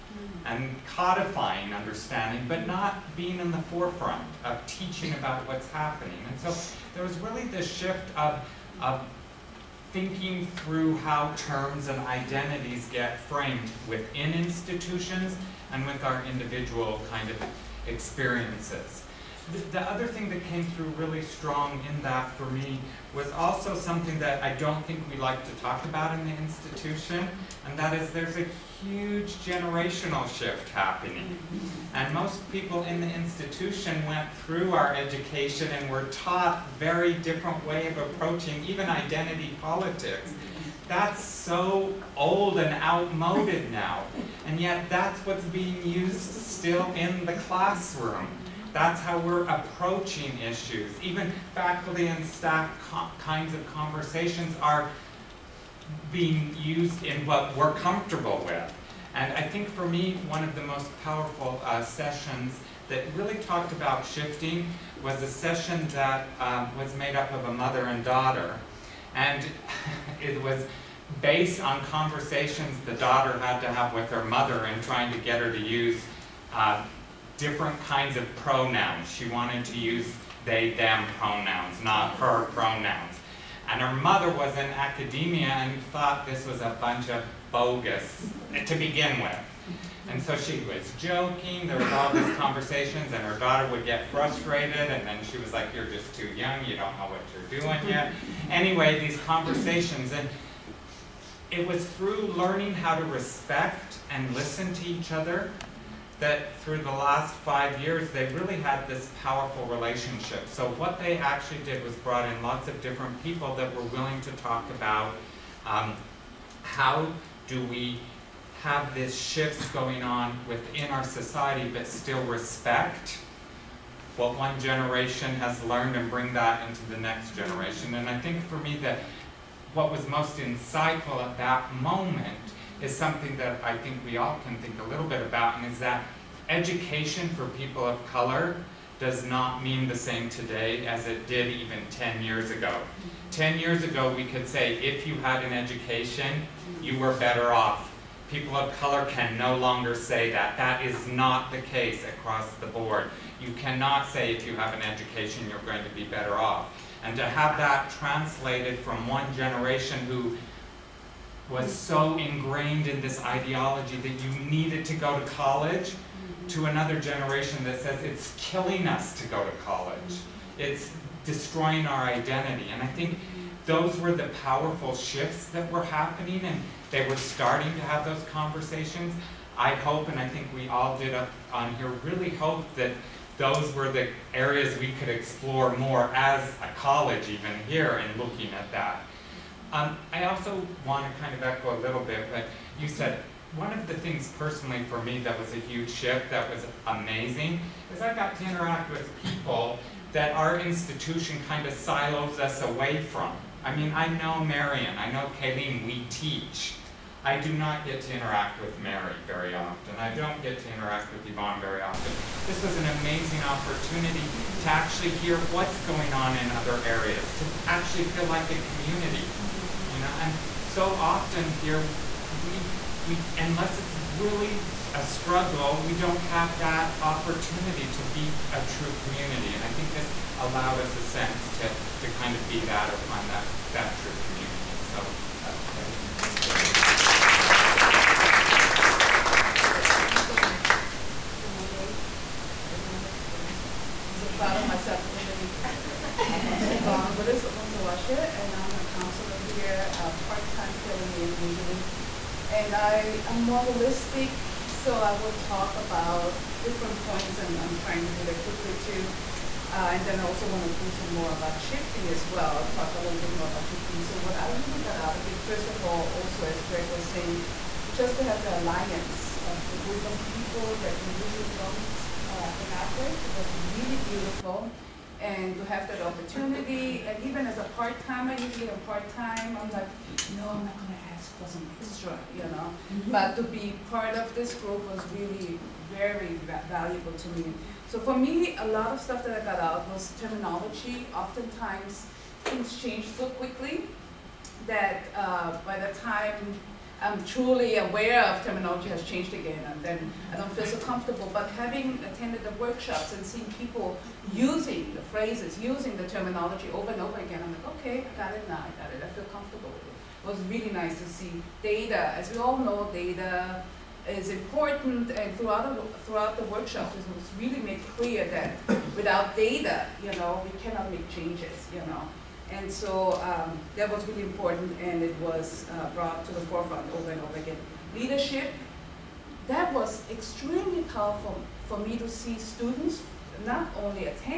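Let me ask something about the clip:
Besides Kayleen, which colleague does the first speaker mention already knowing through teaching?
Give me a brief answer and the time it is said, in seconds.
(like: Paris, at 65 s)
Marion, at 204 s.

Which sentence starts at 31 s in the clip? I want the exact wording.
And most people in the institution went through our education and were taught very different way of approaching even identity politics.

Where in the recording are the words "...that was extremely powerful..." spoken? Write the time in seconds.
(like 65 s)
329 s.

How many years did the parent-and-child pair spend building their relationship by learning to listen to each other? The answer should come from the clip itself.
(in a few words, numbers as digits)
5.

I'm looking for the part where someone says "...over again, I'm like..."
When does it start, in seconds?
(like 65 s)
307 s.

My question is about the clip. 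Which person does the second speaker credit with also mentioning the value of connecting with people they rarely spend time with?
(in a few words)
Greg.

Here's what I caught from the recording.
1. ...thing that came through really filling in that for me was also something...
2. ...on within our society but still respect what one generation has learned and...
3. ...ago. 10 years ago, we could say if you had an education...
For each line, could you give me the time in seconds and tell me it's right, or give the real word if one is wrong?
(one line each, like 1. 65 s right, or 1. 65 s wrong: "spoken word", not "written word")
1. 20 s wrong: "strong", not "filling"
2. 120 s right
3. 142 s right.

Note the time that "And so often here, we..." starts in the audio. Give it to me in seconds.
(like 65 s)
220 s.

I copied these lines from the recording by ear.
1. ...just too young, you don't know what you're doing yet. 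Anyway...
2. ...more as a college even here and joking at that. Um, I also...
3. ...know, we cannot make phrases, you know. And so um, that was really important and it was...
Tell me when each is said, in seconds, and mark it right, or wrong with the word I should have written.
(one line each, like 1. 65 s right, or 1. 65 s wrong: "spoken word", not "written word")
1. 95 s right
2. 185 s wrong: "looking", not "joking"
3. 320 s wrong: "changes", not "phrases".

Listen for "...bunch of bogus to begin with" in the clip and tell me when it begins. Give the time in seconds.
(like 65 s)
86 s.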